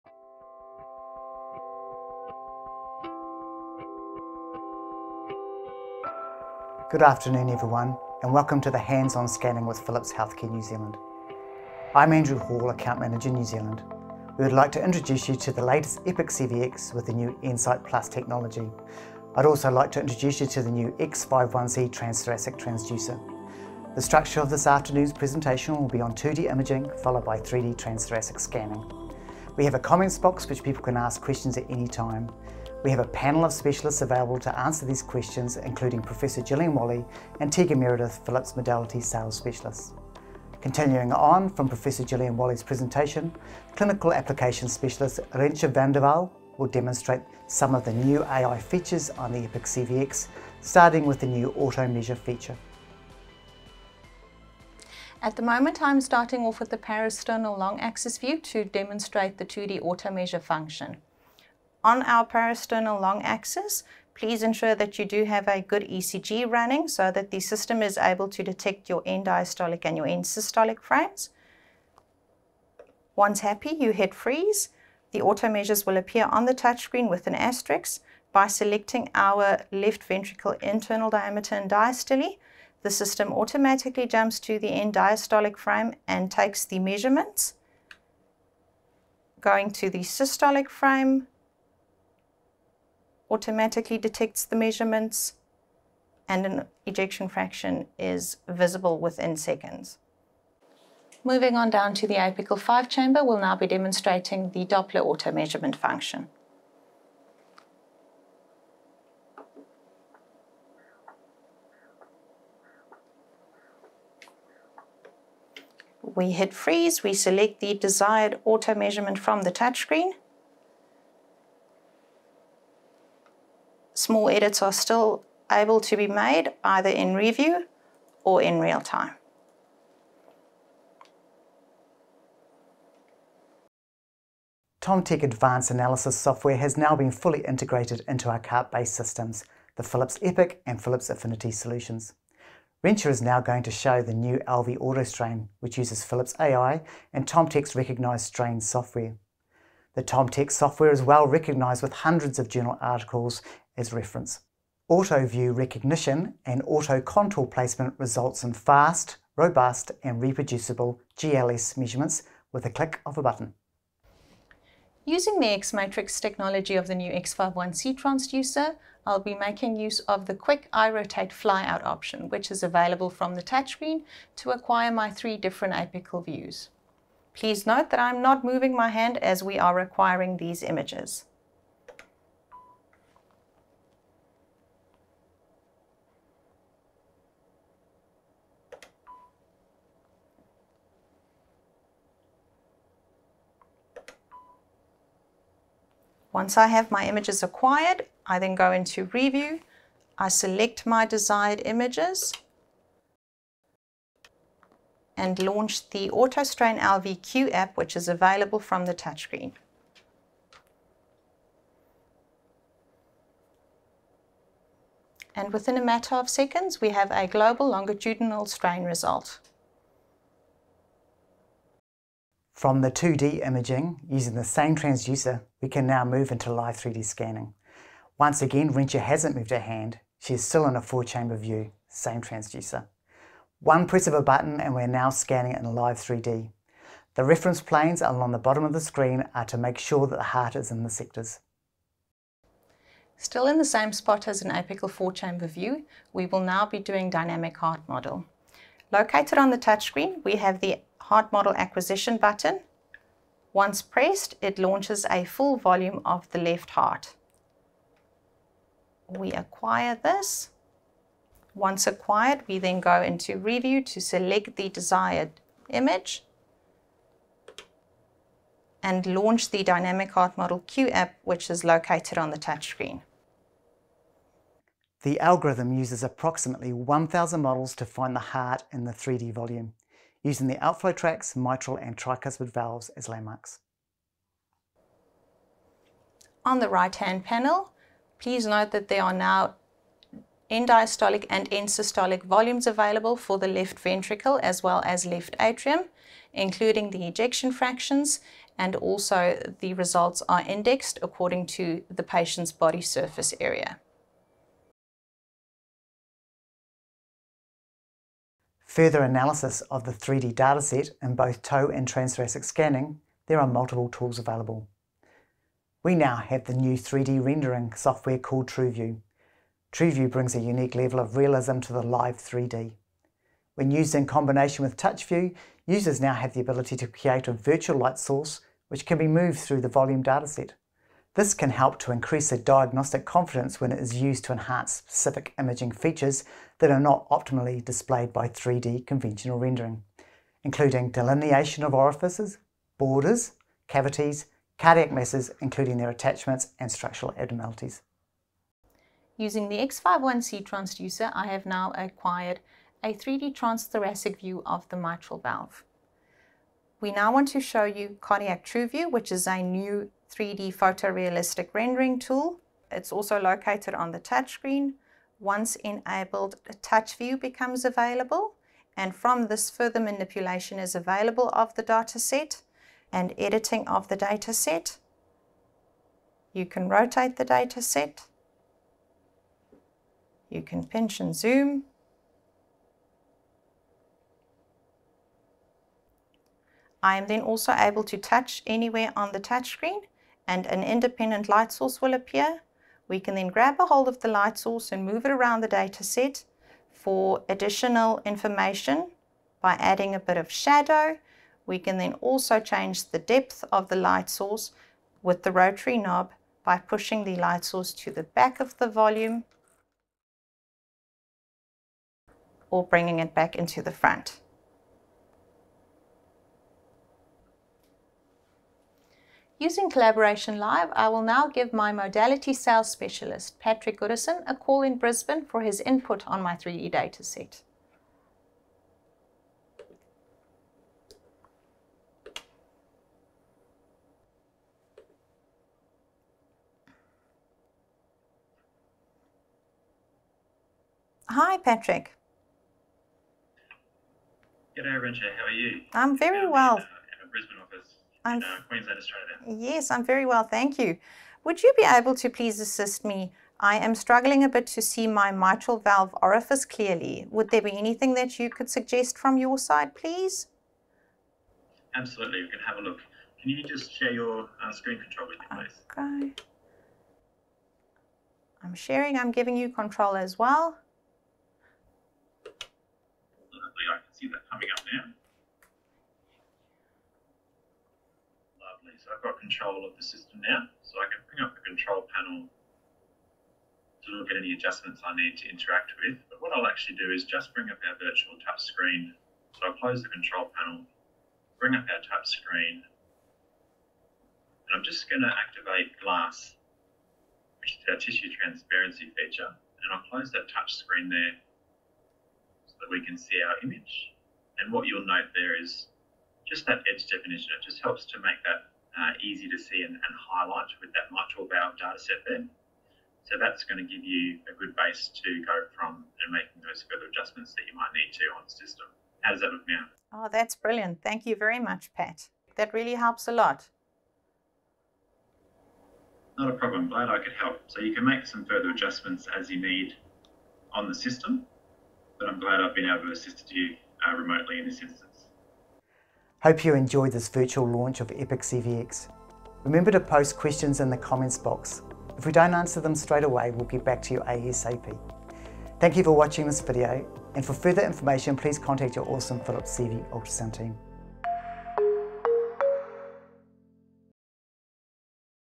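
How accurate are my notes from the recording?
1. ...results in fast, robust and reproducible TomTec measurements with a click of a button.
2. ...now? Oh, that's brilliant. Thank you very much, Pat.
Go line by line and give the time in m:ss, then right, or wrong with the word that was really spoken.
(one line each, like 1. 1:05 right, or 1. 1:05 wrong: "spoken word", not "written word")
1. 2:37 wrong: "GLS", not "TomTec"
2. 8:39 right.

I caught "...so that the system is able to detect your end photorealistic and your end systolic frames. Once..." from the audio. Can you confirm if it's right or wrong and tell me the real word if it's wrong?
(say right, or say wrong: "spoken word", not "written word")
wrong: "diastolic", not "photorealistic".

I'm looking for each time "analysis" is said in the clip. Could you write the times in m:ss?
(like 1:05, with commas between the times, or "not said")
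2:15, 5:09.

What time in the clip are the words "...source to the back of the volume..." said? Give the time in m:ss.
6:47.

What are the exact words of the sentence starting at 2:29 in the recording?
The TomTec software is well recognised with hundreds of journal articles as reference.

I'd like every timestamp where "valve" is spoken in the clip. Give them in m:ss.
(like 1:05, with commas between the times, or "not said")
4:42, 5:55, 7:35, 8:31.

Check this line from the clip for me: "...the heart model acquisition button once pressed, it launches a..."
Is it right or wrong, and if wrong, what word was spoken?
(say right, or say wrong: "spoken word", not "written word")
right.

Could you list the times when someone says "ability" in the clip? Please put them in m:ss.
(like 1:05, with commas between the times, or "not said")
5:26.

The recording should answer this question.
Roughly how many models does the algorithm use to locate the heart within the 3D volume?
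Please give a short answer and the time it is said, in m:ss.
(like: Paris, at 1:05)
1,000, at 4:36.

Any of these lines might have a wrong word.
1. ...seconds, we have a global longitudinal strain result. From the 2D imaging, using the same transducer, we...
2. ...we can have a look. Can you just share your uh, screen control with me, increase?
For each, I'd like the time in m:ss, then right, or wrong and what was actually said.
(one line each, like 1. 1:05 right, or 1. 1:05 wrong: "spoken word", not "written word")
1. 3:36 right
2. 7:42 wrong: "please", not "increase".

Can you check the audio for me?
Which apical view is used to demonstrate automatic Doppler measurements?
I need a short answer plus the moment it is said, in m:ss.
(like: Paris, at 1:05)
Apical 5 chamber, at 1:42.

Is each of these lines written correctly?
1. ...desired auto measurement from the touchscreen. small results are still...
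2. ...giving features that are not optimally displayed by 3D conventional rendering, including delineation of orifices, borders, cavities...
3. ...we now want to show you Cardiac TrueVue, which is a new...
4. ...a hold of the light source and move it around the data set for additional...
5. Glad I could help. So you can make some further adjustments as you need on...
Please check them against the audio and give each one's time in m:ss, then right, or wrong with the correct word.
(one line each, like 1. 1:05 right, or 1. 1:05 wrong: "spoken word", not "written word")
1. 1:57 wrong: "edits", not "results"
2. 5:35 wrong: "imaging", not "giving"
3. 5:56 right
4. 6:33 right
5. 8:46 right.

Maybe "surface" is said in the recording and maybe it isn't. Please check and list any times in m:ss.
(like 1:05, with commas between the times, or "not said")
5:02.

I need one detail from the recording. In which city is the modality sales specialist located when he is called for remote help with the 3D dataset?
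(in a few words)
Brisbane.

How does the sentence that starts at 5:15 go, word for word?
We now have the new 3D rendering software called TrueVue.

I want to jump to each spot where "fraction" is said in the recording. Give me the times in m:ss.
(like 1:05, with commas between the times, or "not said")
1:37, 4:57.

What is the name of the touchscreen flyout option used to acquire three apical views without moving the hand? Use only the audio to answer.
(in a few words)
iRotate.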